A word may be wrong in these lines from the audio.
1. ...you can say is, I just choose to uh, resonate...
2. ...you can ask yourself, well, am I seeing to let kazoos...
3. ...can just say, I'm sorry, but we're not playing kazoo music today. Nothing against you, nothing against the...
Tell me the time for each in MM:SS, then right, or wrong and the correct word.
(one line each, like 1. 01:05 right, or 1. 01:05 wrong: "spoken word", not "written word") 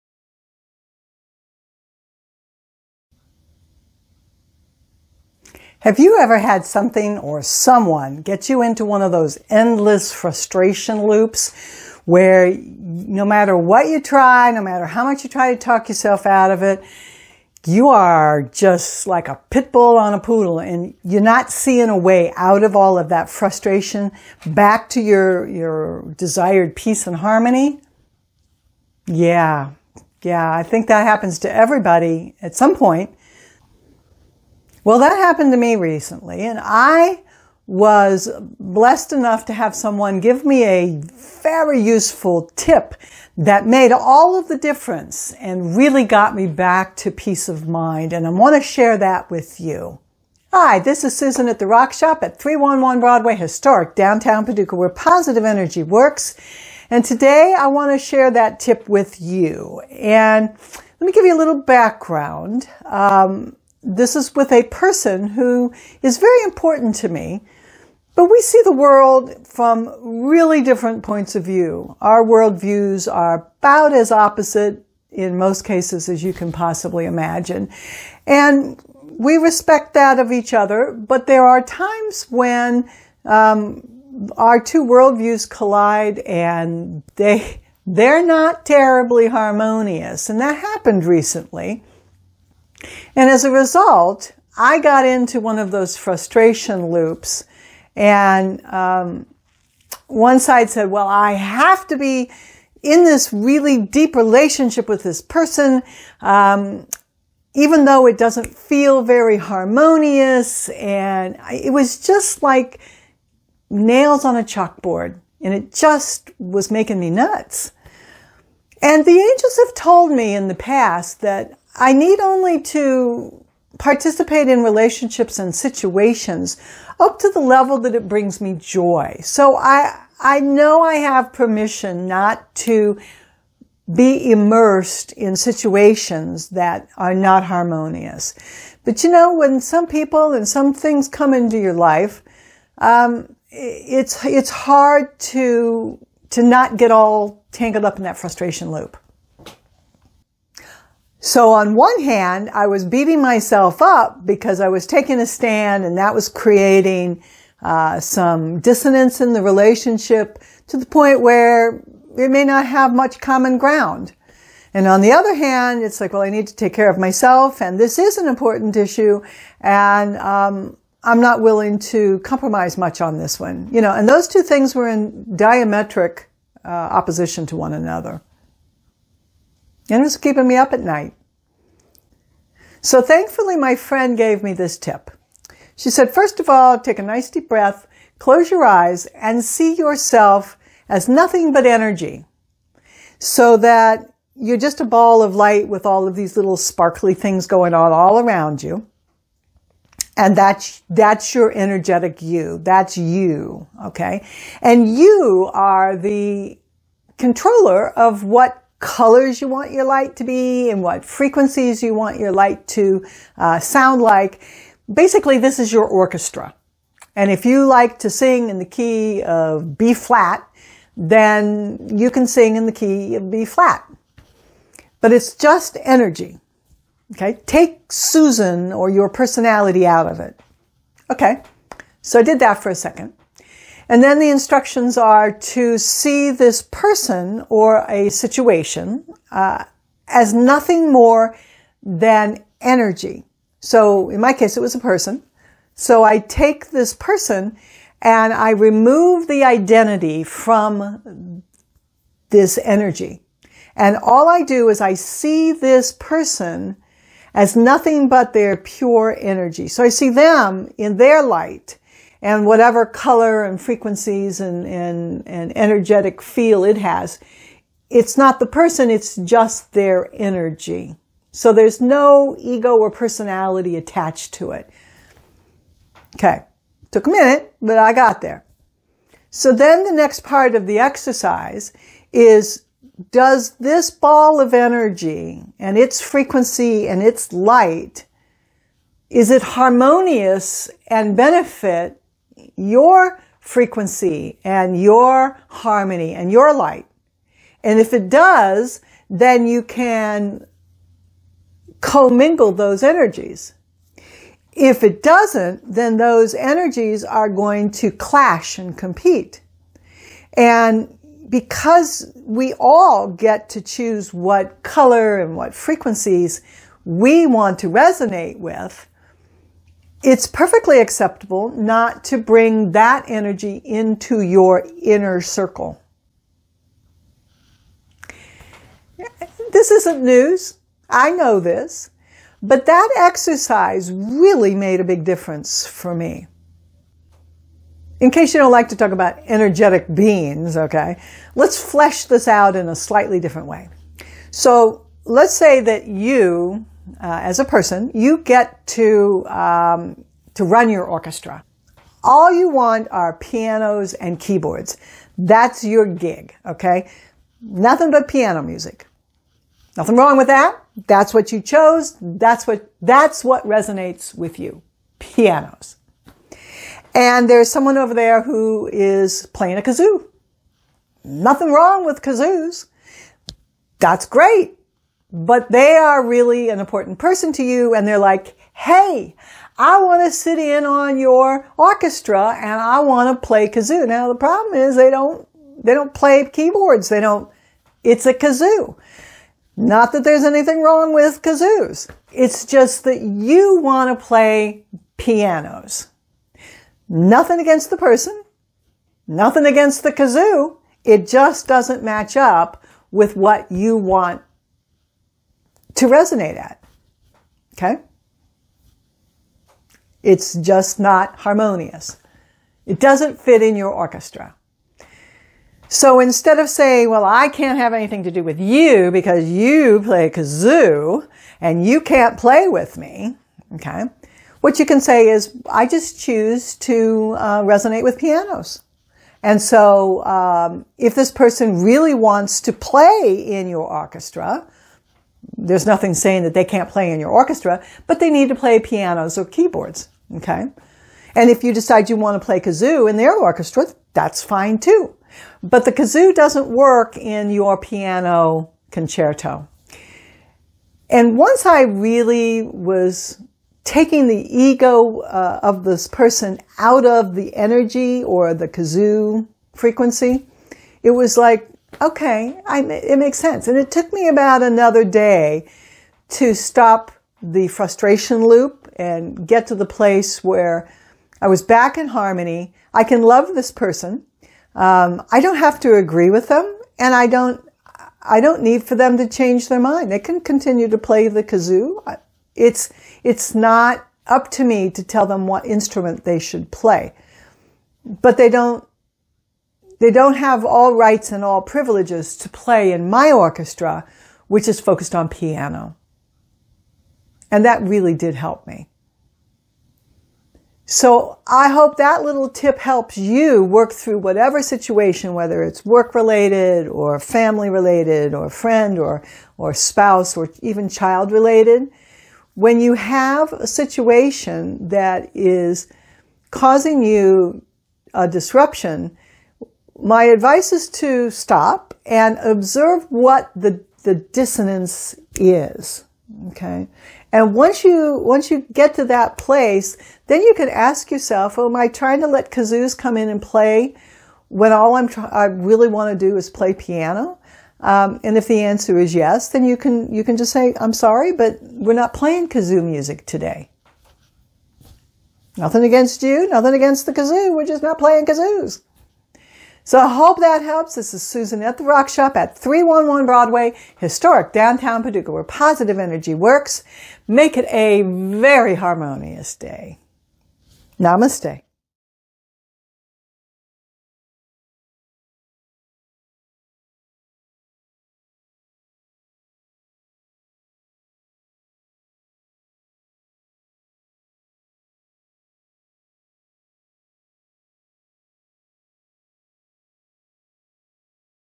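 1. 07:04 right
2. 08:50 wrong: "trying", not "seeing"
3. 09:00 right.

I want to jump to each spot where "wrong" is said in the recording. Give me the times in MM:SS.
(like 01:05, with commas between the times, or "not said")
05:59, 06:11, 06:30.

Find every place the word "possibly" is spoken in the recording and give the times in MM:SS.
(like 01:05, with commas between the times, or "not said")
01:16.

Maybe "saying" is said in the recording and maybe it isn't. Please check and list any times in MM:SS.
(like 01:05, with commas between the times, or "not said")
06:56, 07:15.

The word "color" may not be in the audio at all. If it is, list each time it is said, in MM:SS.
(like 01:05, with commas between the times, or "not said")
03:28, 04:22, 05:14.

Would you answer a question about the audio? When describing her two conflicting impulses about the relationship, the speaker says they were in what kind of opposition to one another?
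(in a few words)
Diametric.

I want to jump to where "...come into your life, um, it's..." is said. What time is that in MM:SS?
02:21.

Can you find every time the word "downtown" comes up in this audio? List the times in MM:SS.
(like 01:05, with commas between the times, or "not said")
00:53, 09:14.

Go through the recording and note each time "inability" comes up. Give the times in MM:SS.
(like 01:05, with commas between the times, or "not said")
not said.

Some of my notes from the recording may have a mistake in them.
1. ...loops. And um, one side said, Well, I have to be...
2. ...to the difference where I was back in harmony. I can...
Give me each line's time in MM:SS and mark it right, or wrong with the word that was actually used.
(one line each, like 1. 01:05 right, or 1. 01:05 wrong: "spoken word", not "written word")
1. 01:36 right
2. 07:49 wrong: "place", not "difference".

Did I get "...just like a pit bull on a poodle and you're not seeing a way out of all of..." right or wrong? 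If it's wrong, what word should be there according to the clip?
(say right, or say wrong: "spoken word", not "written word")
right.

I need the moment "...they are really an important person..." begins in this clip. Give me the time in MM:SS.
06:15.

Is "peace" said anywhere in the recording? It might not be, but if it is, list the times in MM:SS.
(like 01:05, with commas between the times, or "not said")
00:26, 00:47.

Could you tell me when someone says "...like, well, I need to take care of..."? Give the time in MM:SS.
02:46.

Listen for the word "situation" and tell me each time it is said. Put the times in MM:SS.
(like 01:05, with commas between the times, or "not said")
02:05, 02:15, 03:58, 08:24, 08:33.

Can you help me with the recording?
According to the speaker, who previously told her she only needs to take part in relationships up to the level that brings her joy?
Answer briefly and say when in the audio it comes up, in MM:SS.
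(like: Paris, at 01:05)
The angels, at 01:59.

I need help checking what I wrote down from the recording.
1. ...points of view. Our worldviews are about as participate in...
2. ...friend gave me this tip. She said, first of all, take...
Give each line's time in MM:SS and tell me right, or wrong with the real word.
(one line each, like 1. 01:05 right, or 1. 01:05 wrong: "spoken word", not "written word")
1. 01:11 wrong: "opposite", not "participate"
2. 03:03 right.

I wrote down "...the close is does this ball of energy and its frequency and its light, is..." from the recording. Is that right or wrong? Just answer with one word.
wrong.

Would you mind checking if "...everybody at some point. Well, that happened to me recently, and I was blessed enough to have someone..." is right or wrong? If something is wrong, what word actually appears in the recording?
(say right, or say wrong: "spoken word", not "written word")
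right.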